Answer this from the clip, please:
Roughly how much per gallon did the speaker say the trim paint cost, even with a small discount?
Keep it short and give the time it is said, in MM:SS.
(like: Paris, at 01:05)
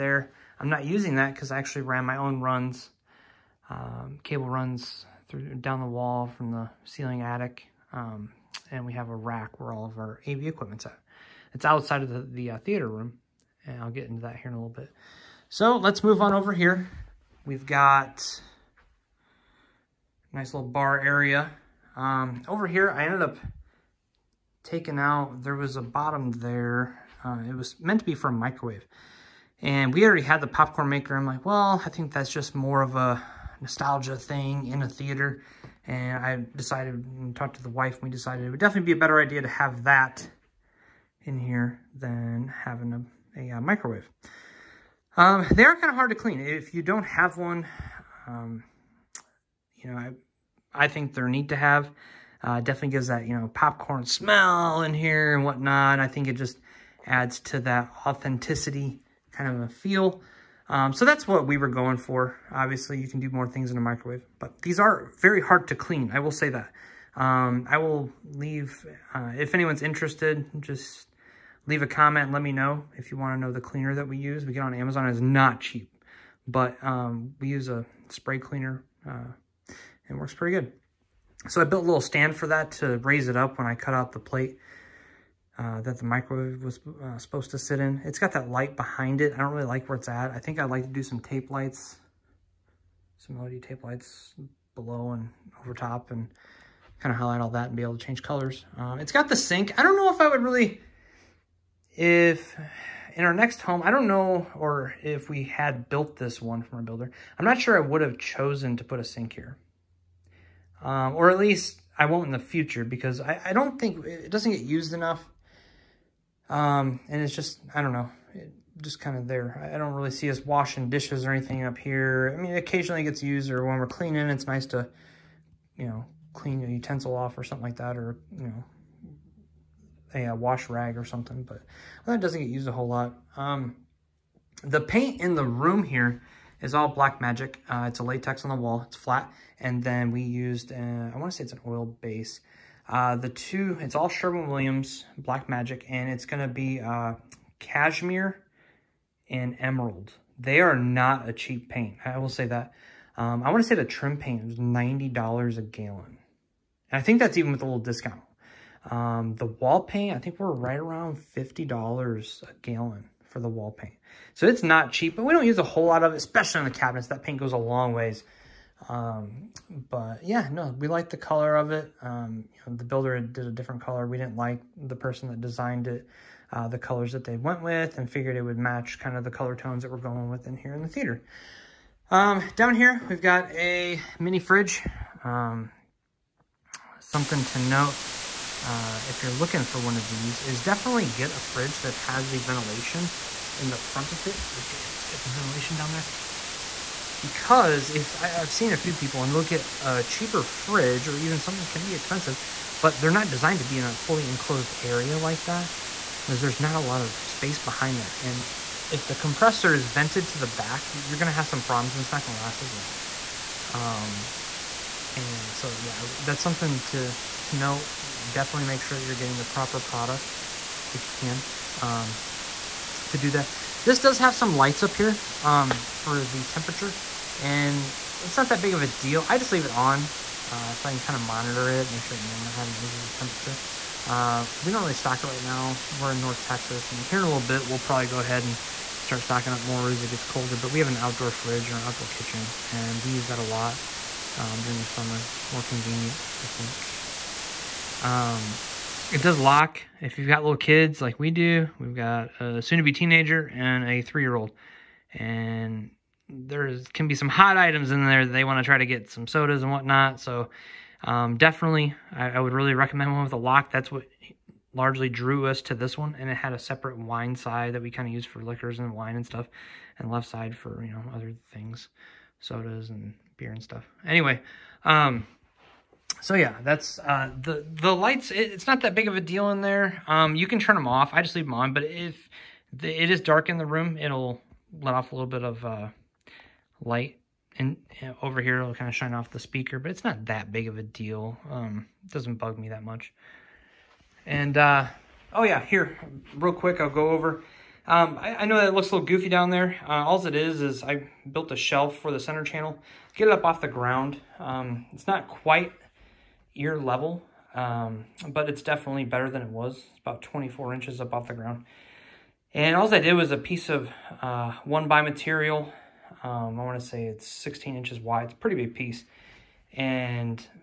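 $90, at 02:34.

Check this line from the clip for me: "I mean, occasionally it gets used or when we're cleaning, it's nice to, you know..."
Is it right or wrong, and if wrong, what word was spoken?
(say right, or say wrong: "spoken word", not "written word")
right.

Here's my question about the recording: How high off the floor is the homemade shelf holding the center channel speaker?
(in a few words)
24 inches.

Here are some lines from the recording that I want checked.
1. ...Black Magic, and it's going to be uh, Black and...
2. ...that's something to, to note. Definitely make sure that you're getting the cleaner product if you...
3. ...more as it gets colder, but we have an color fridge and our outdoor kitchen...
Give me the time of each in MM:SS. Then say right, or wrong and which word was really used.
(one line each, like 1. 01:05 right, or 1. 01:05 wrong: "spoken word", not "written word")
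1. 02:25 wrong: "Cashmere", not "Black"
2. 03:36 wrong: "proper", not "cleaner"
3. 03:59 wrong: "outdoor", not "color".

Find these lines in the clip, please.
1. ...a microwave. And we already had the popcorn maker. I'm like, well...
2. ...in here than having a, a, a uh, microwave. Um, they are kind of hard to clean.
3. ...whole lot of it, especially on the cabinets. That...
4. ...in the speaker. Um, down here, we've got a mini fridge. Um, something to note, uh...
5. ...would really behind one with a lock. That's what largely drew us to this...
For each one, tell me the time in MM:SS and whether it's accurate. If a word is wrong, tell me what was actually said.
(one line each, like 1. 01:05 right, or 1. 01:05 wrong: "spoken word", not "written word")
1. 00:28 right
2. 00:41 right
3. 02:45 right
4. 03:00 wrong: "theater", not "speaker"
5. 04:22 wrong: "recommend", not "behind".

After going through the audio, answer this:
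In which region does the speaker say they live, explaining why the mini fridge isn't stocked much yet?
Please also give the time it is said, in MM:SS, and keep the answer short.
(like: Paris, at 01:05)
North Texas, at 03:56.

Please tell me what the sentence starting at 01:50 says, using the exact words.
Um, or at least I won't in the future because I, I don't think it doesn't get used enough.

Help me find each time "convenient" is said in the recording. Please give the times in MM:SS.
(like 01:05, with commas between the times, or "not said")
04:05.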